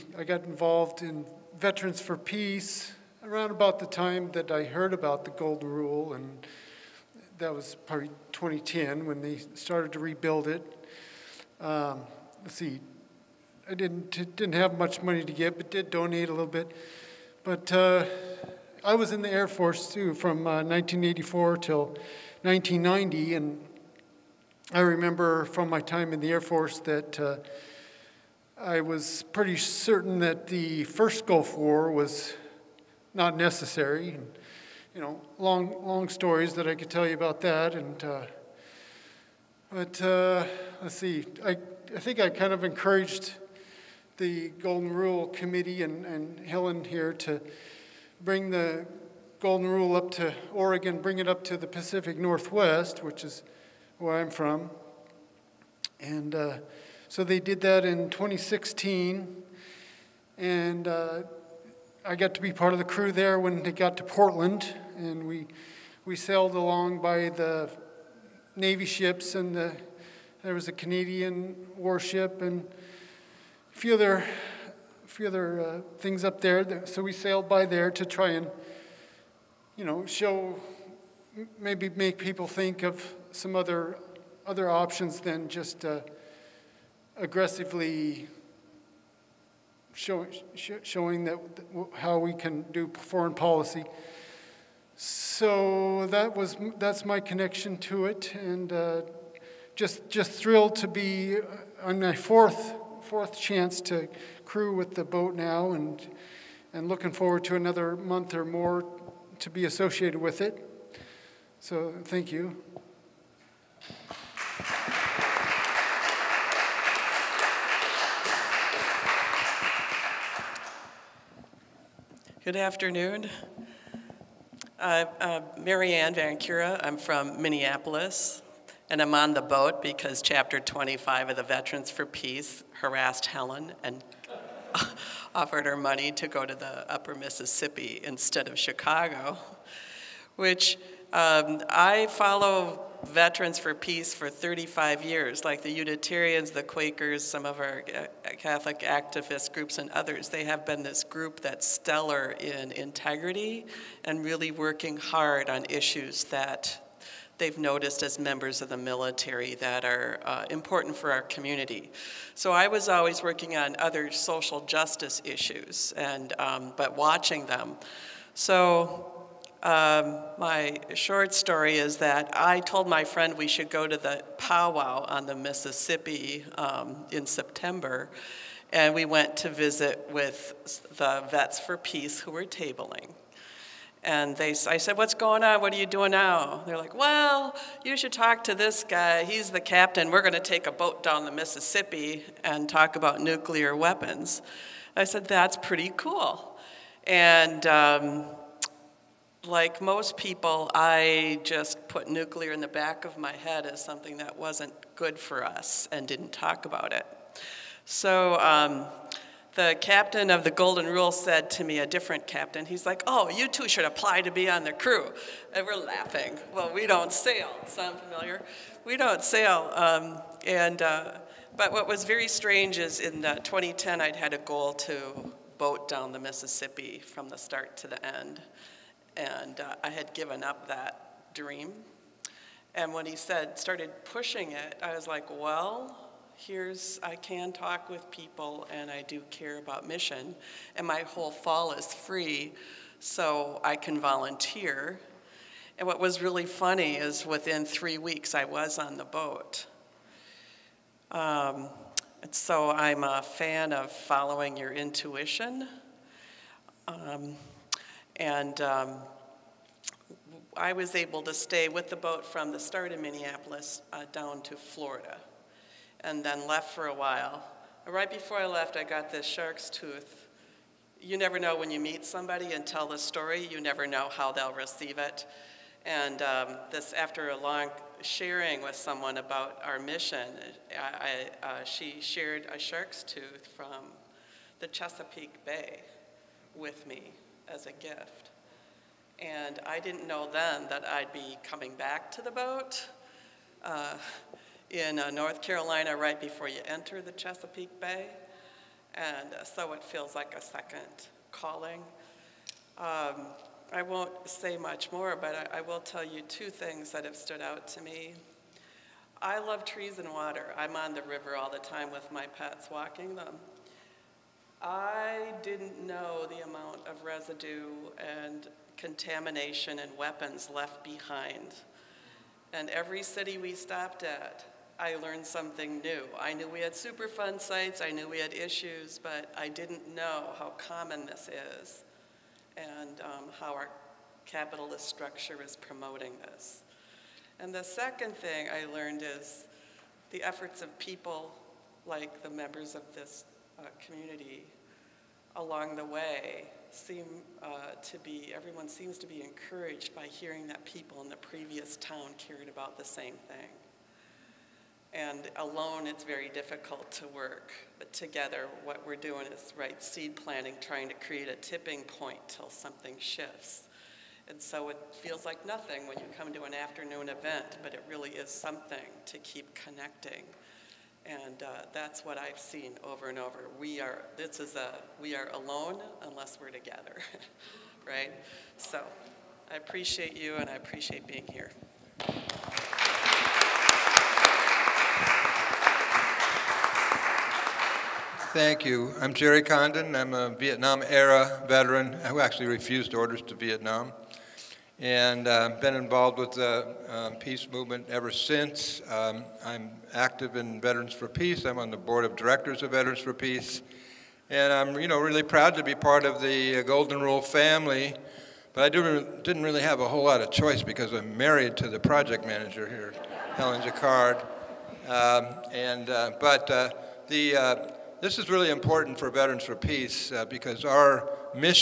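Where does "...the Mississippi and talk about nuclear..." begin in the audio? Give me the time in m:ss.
3:11.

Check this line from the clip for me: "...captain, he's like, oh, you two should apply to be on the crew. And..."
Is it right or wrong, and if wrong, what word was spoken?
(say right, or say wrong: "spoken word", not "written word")
right.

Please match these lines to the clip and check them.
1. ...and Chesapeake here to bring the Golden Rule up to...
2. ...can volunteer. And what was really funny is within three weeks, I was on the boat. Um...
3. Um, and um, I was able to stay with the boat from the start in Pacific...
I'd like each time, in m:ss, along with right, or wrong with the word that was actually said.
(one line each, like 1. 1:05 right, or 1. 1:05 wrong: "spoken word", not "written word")
1. 0:46 wrong: "Helen", not "Chesapeake"
2. 4:03 right
3. 4:16 wrong: "Minneapolis", not "Pacific".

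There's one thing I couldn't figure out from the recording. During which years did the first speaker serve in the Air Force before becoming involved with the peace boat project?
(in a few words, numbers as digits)
1984 to 1990.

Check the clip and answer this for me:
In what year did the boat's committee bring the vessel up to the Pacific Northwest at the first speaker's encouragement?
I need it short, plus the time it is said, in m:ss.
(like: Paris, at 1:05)
2016, at 0:58.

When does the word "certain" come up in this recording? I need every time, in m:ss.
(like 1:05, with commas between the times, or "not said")
0:29.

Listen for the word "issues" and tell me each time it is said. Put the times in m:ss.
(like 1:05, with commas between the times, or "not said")
2:35, 2:45, 5:28.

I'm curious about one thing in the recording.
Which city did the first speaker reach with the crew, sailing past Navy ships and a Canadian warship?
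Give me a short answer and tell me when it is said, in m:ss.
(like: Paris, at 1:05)
Portland, at 1:04.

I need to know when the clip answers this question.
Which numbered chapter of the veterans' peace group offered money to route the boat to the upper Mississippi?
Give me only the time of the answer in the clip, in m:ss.
2:10.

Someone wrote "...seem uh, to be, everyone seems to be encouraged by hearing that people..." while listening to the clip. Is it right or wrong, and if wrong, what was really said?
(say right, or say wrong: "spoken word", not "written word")
right.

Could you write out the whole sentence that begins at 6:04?
And so it feels like nothing when you come to an afternoon event, but it really is something to keep connecting.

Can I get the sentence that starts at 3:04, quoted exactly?
And they, I said, What's going on?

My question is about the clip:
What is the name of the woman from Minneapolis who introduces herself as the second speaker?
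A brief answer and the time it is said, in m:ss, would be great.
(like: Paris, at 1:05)
Marianne Van Cura, at 2:05.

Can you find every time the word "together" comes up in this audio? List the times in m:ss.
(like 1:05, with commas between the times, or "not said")
5:57, 6:16.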